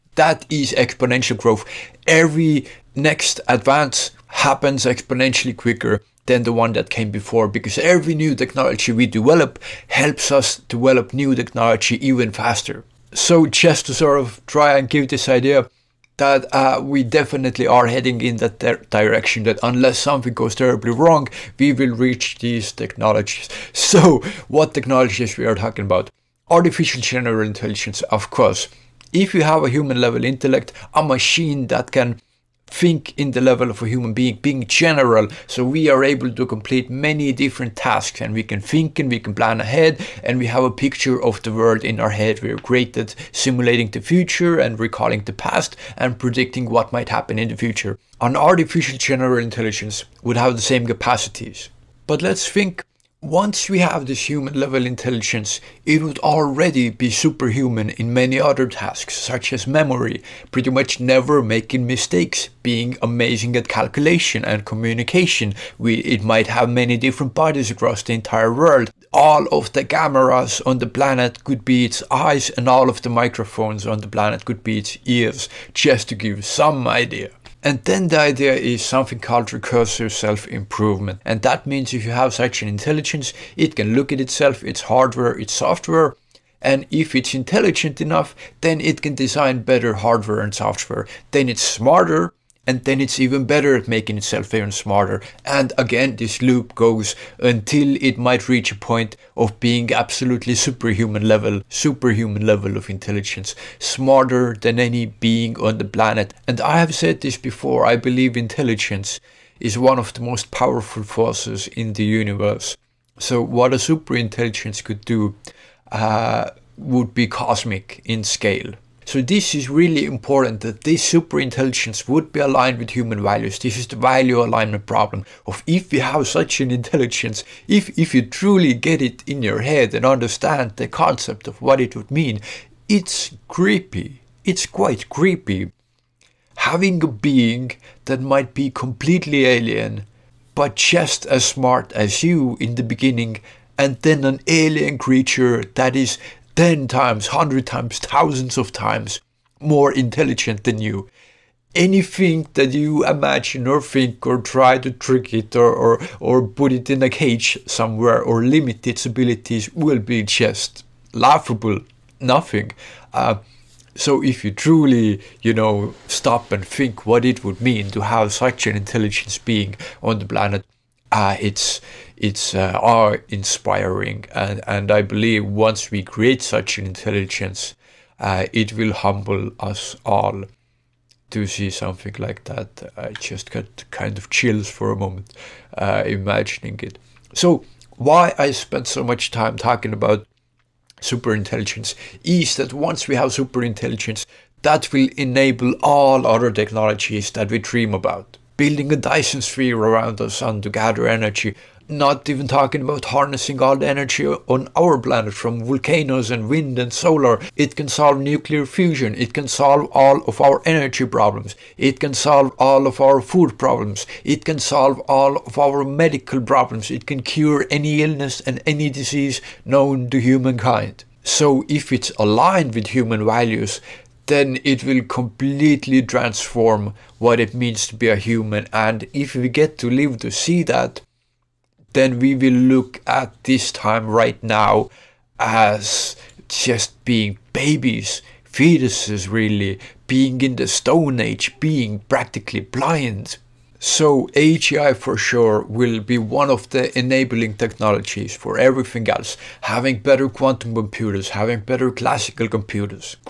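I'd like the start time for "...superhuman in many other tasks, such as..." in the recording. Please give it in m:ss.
0:57.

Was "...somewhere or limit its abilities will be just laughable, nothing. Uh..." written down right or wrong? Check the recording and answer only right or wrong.
right.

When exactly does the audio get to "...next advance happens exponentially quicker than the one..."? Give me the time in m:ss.
0:02.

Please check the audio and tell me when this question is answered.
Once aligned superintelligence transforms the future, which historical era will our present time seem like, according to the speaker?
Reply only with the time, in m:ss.
4:00.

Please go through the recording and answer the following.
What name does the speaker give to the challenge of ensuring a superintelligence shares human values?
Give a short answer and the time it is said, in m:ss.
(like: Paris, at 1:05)
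value alignment problem, at 2:03.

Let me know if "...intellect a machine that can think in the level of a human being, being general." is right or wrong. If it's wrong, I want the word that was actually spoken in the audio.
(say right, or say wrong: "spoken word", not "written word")
right.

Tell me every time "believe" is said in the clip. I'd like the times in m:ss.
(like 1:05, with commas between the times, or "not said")
1:47, 2:55.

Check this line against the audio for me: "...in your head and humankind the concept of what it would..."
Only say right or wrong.
wrong.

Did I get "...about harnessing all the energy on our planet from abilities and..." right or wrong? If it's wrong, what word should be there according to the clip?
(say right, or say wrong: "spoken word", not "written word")
wrong: "volcanoes", not "abilities".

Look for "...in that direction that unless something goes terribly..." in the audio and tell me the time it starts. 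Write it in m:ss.
0:18.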